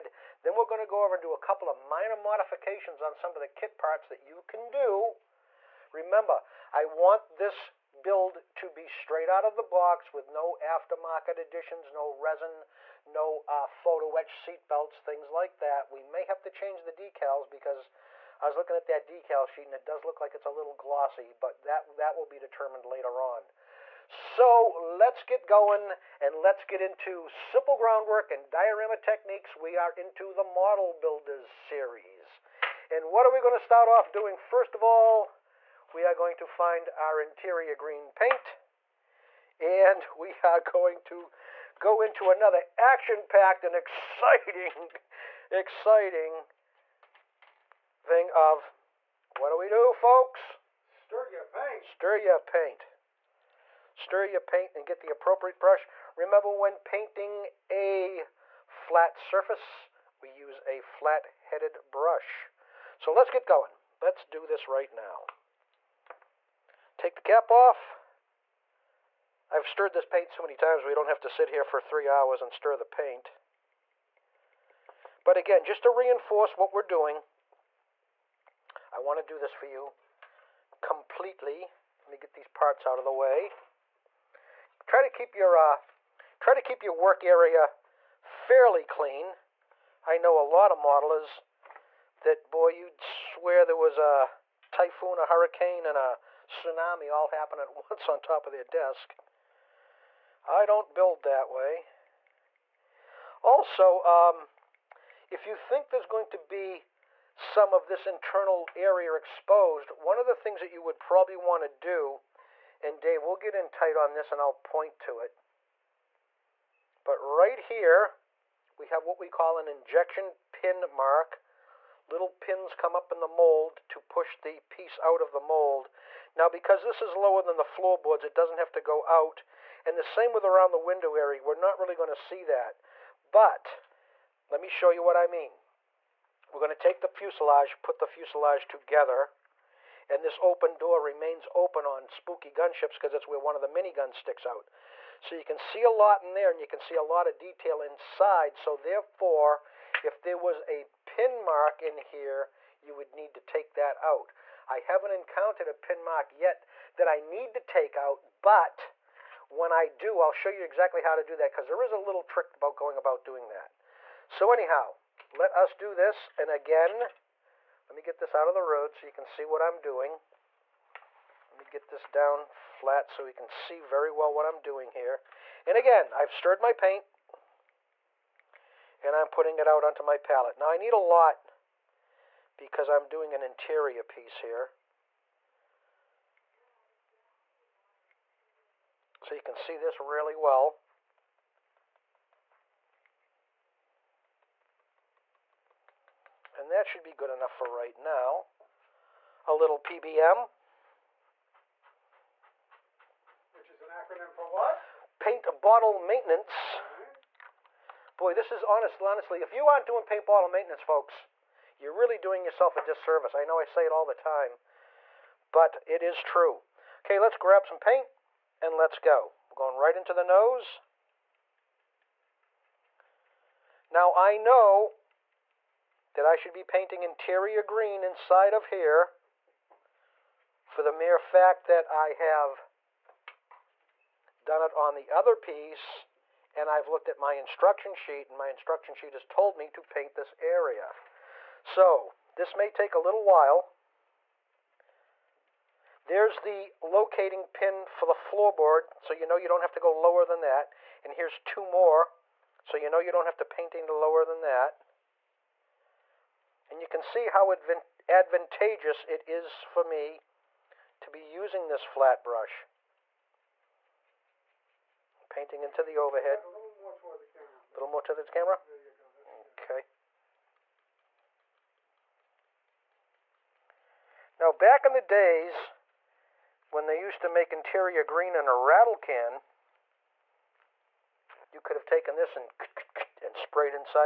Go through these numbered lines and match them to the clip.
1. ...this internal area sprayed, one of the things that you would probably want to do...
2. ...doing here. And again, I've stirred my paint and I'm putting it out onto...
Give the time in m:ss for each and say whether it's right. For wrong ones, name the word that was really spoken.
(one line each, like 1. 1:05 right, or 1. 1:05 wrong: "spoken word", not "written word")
1. 1:47 wrong: "exposed", not "sprayed"
2. 2:54 right.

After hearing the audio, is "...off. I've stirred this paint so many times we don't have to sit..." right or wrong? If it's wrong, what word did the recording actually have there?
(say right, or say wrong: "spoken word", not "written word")
right.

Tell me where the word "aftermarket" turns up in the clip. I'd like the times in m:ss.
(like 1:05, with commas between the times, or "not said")
0:10.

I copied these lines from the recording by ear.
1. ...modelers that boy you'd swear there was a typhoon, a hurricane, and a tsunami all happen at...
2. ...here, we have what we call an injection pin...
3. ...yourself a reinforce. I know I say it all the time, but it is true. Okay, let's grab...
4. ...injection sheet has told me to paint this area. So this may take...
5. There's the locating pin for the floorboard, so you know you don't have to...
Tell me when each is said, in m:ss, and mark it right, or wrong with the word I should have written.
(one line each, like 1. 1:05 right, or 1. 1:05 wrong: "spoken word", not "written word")
1. 1:30 right
2. 1:57 right
3. 3:32 wrong: "disservice", not "reinforce"
4. 3:58 wrong: "instruction", not "injection"
5. 4:06 right.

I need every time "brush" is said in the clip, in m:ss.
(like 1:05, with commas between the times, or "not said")
0:55, 1:01, 4:22.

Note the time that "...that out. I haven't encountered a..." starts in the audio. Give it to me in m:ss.
2:33.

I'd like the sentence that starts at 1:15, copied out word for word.
But again, just to reinforce what we're doing, I want to do this for you completely.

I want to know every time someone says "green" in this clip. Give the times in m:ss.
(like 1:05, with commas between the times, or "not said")
0:37, 3:47, 4:38.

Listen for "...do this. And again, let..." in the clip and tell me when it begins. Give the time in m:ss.
2:45.